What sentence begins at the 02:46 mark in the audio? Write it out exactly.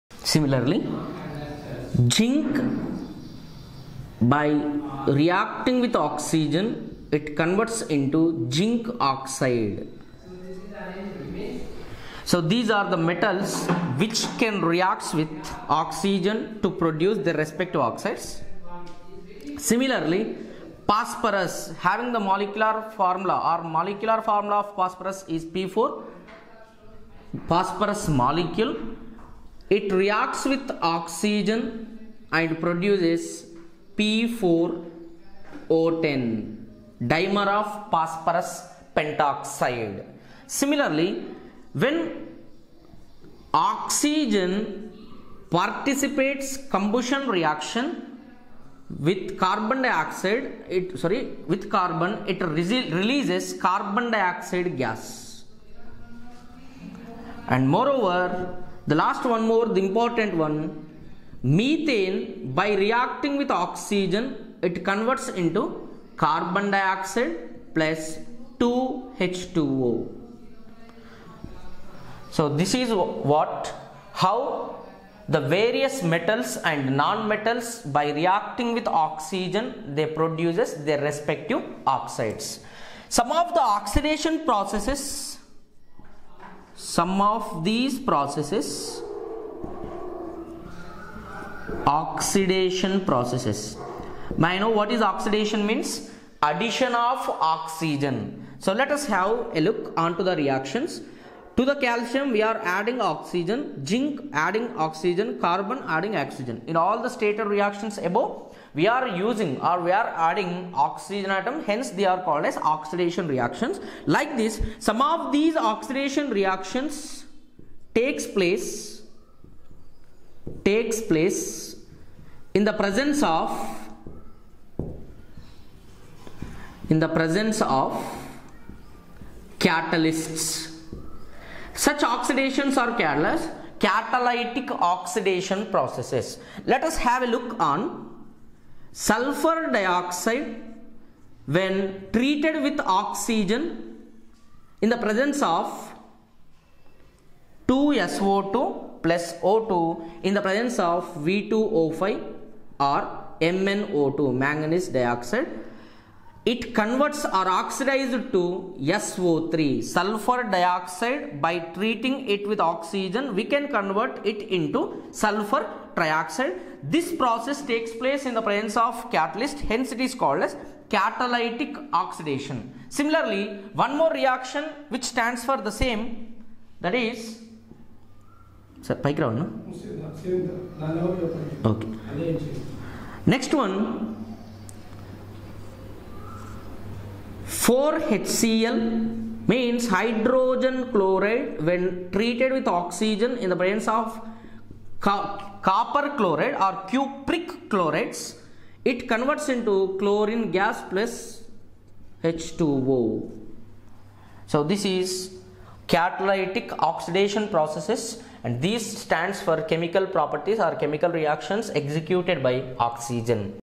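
This process takes place in the presence of catalyst, hence it is called as catalytic oxidation.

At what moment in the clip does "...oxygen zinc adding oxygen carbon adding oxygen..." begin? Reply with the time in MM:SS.
01:43.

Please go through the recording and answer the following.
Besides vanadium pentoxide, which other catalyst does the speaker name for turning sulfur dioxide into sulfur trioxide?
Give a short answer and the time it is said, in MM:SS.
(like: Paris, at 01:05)
Manganese dioxide, at 02:34.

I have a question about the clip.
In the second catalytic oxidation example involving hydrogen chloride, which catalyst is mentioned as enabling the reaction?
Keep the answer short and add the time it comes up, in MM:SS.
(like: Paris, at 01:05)
Copper chloride, at 03:15.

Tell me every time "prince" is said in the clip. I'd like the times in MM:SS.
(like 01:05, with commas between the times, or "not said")
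not said.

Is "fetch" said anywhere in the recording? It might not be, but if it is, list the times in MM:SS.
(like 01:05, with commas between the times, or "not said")
not said.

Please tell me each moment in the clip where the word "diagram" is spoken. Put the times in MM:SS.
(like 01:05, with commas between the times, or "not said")
not said.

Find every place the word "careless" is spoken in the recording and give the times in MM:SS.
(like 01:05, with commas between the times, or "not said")
02:12.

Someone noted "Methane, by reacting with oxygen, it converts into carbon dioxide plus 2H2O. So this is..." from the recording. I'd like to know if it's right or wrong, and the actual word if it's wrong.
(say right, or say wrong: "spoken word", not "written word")
right.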